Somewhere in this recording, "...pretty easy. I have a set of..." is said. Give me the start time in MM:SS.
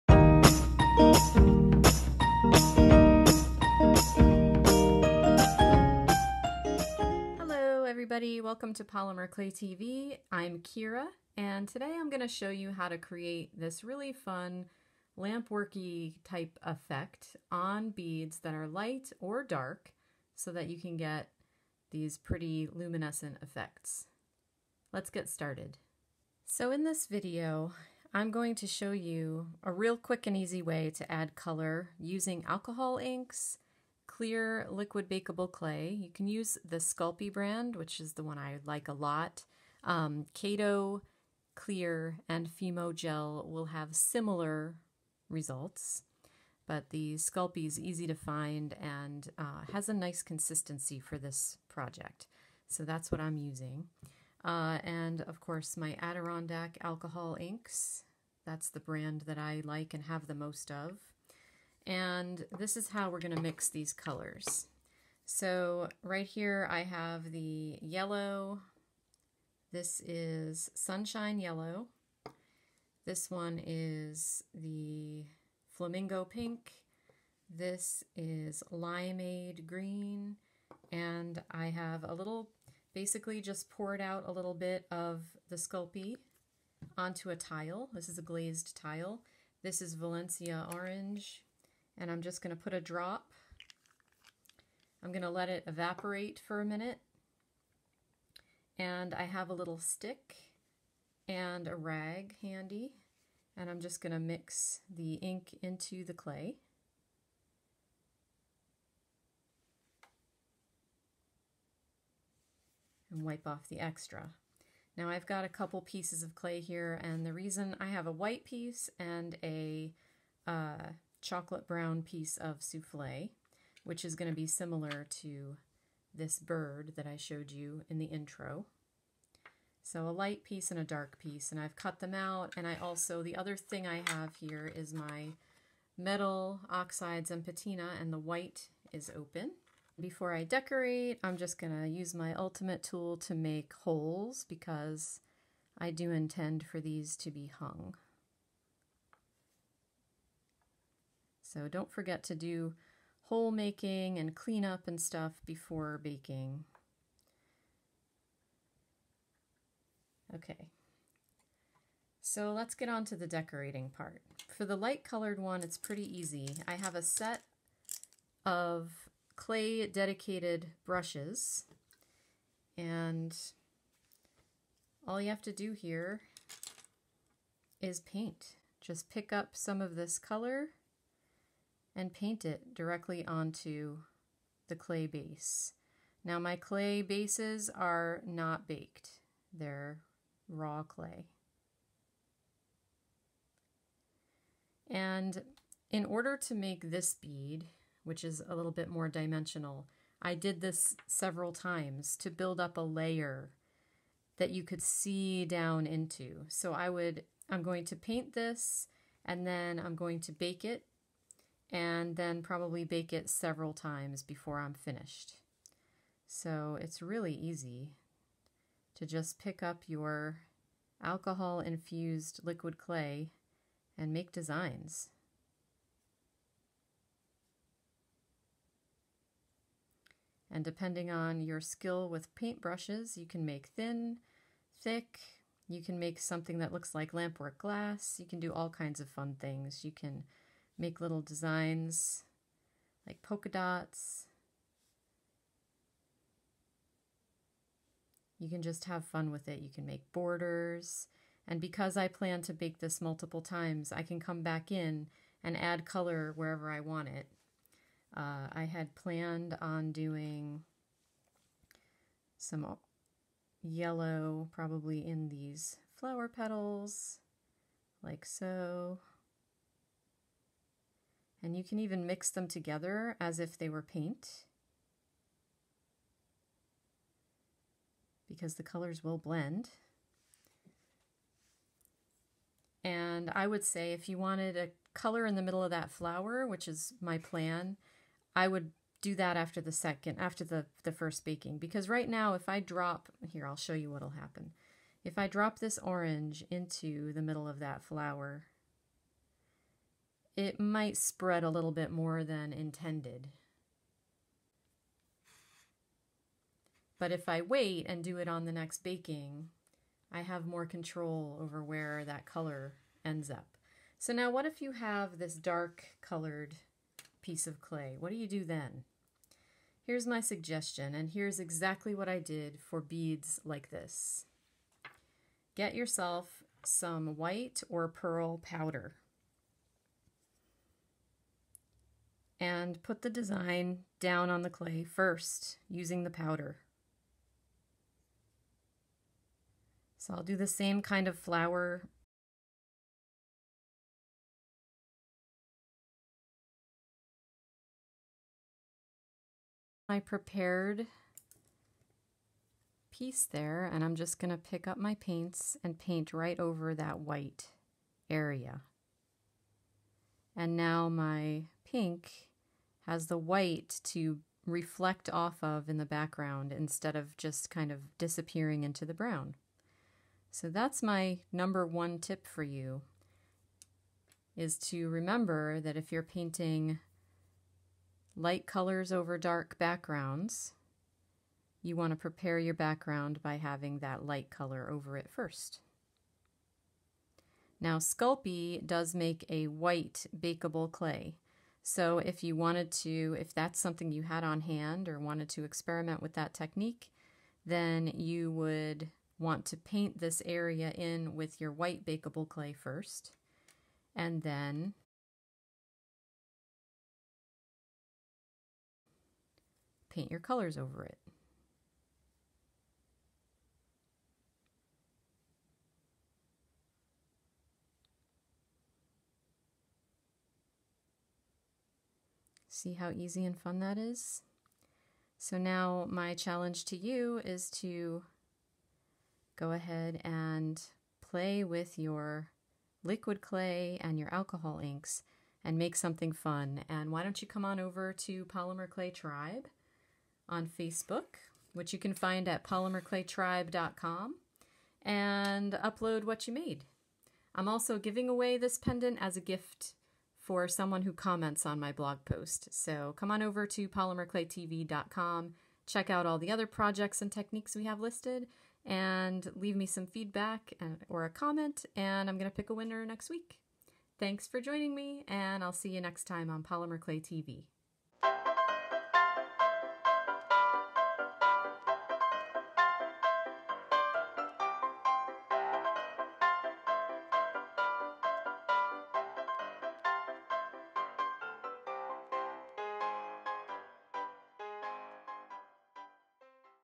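02:45.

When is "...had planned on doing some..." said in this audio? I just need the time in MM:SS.
04:18.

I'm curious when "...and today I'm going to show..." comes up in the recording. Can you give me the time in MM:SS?
00:11.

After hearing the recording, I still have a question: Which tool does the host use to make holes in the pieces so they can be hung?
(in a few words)
Ultimate tool.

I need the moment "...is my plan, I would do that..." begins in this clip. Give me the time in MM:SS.
04:46.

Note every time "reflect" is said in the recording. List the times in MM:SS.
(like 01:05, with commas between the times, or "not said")
06:04.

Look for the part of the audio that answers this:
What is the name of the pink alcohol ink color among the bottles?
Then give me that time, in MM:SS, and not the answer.
01:15.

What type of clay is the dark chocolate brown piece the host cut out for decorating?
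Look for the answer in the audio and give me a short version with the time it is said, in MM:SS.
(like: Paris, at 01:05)
Souffle, at 02:02.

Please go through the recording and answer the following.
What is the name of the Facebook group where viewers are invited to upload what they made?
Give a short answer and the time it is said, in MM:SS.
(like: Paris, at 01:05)
Polymer Clay Tribe, at 07:18.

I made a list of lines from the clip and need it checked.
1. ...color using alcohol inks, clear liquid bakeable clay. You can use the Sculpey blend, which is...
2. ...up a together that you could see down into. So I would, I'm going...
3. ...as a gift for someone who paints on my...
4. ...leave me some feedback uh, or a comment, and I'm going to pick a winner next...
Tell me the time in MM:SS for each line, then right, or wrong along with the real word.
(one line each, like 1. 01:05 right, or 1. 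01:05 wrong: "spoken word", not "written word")
1. 00:31 wrong: "brand", not "blend"
2. 03:22 wrong: "layer", not "together"
3. 07:28 wrong: "comments", not "paints"
4. 07:39 right.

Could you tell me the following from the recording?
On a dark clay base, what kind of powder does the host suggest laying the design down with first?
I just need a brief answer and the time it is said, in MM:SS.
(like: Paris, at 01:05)
White or pearl powder, at 05:27.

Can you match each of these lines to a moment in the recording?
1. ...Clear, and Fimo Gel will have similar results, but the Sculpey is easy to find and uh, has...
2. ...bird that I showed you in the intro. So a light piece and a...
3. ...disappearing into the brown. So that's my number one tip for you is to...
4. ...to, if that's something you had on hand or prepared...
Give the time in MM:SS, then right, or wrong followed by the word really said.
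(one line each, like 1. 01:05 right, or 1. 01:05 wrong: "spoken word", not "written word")
1. 00:41 right
2. 02:06 right
3. 06:07 right
4. 06:32 wrong: "wanted", not "prepared".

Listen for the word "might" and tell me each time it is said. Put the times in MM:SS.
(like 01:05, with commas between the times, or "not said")
05:00.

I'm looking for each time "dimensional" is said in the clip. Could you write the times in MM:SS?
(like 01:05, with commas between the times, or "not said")
03:19.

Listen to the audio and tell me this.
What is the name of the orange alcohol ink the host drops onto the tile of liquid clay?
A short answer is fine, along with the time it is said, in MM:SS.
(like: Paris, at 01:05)
Valencia Orange, at 01:29.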